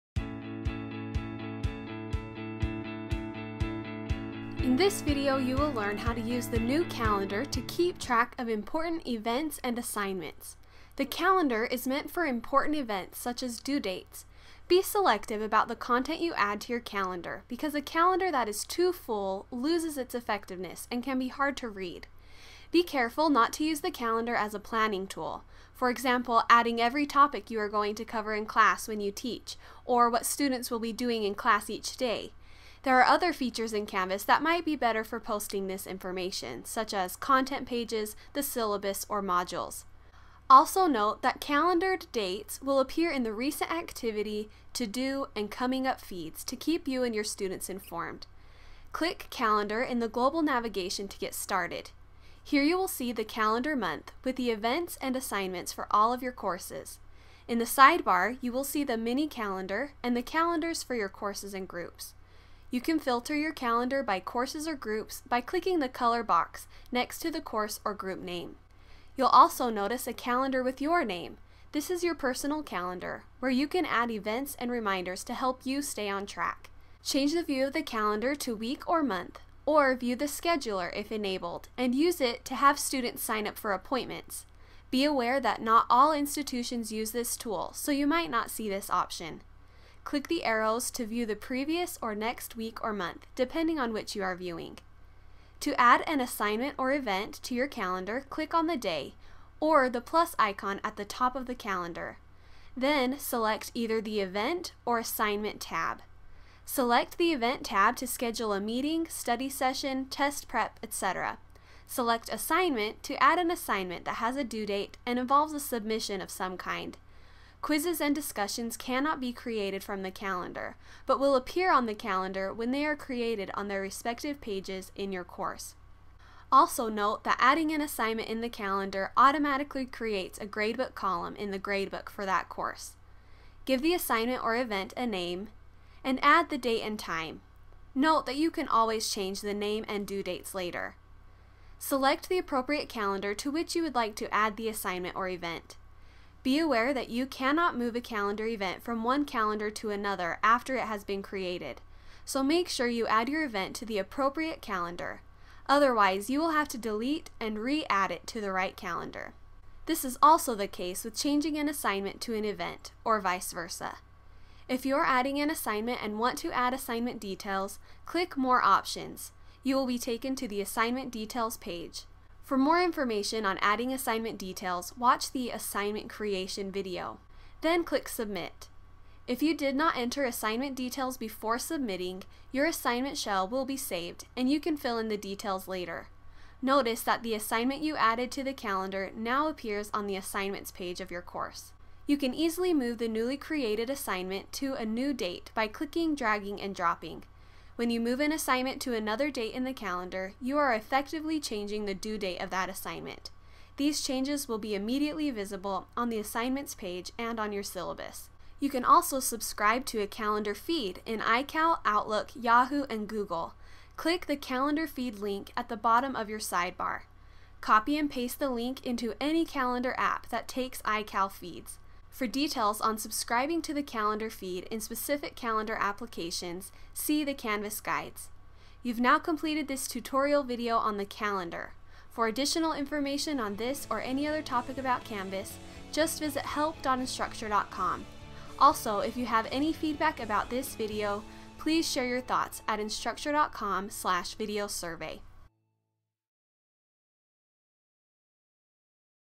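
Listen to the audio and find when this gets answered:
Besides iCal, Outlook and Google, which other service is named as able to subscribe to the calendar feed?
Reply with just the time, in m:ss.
3:32.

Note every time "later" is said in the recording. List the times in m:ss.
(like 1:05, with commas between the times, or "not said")
2:20, 3:05.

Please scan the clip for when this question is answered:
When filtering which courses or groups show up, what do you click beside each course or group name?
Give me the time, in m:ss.
1:05.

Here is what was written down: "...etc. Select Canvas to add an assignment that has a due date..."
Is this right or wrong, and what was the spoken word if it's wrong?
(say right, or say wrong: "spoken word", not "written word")
wrong: "Assignment", not "Canvas".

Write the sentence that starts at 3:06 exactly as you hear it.
Notice that the assignment you added to the calendar now appears on the assignments page of your course.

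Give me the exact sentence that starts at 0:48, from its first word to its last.
Click Calendar in the global navigation to get started.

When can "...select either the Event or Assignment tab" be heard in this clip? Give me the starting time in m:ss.
1:43.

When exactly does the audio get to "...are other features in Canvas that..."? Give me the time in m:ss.
0:32.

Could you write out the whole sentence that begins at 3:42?
For details on subscribing to the calendar feed in specific calendar applications, see the Canvas guides.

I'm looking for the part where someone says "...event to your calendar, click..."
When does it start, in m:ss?
1:36.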